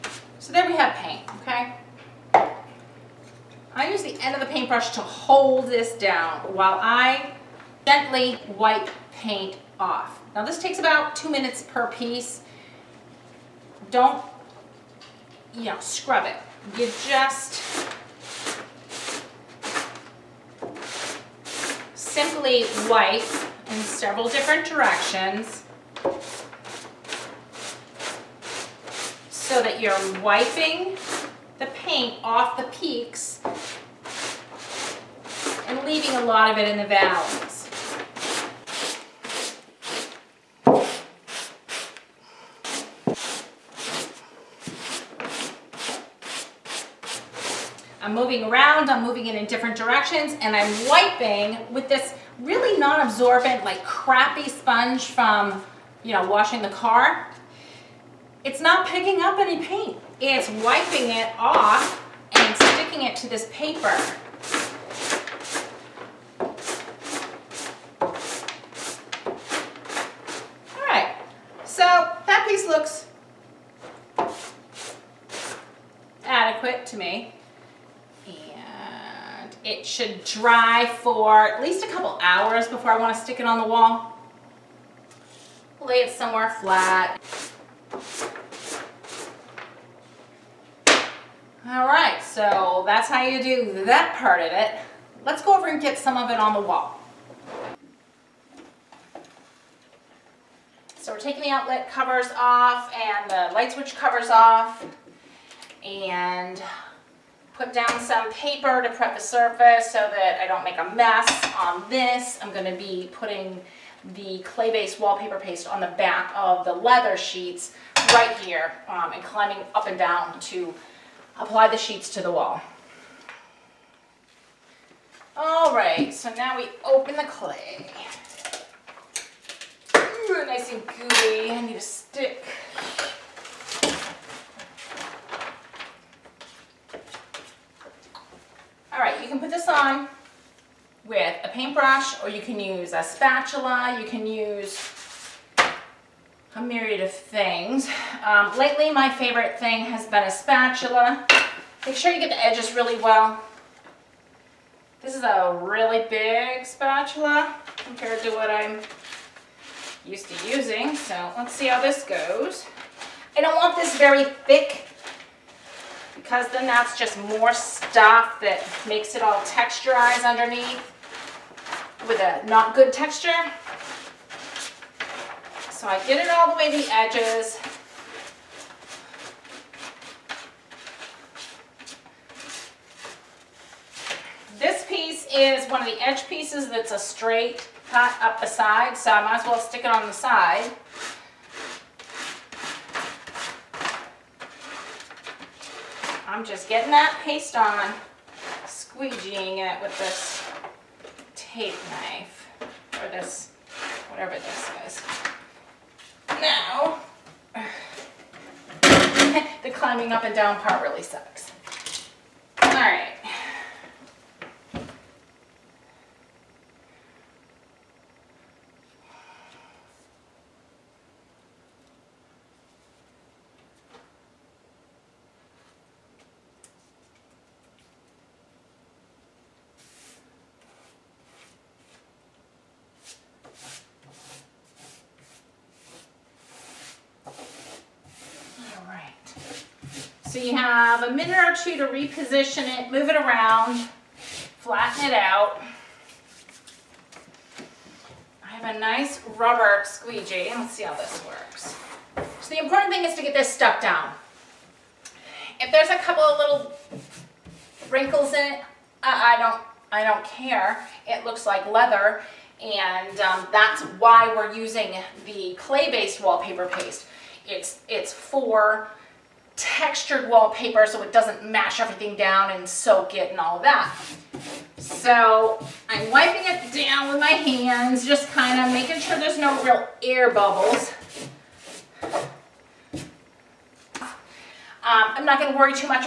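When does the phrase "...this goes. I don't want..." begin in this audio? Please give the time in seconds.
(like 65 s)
161 s.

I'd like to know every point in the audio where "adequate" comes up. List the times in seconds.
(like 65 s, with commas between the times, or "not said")
76 s.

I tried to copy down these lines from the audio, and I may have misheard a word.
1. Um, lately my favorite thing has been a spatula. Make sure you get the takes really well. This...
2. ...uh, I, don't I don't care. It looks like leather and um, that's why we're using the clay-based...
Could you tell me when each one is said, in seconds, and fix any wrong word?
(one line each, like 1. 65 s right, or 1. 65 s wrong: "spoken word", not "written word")
1. 148 s wrong: "edges", not "takes"
2. 258 s right.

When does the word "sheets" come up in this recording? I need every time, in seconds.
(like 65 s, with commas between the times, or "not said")
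117 s, 121 s.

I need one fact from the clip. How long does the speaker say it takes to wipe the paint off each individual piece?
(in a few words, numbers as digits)
2 minutes.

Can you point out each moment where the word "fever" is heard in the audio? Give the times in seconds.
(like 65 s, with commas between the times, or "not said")
not said.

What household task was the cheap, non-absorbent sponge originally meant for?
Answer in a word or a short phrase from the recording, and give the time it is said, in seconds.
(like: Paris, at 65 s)
Washing the car, at 56 s.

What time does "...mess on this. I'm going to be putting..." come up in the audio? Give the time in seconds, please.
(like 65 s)
110 s.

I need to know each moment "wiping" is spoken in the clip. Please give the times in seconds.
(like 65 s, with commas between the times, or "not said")
30 s, 50 s, 60 s, 276 s.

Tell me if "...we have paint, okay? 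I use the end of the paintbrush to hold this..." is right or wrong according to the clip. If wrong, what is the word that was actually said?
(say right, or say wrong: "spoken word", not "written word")
right.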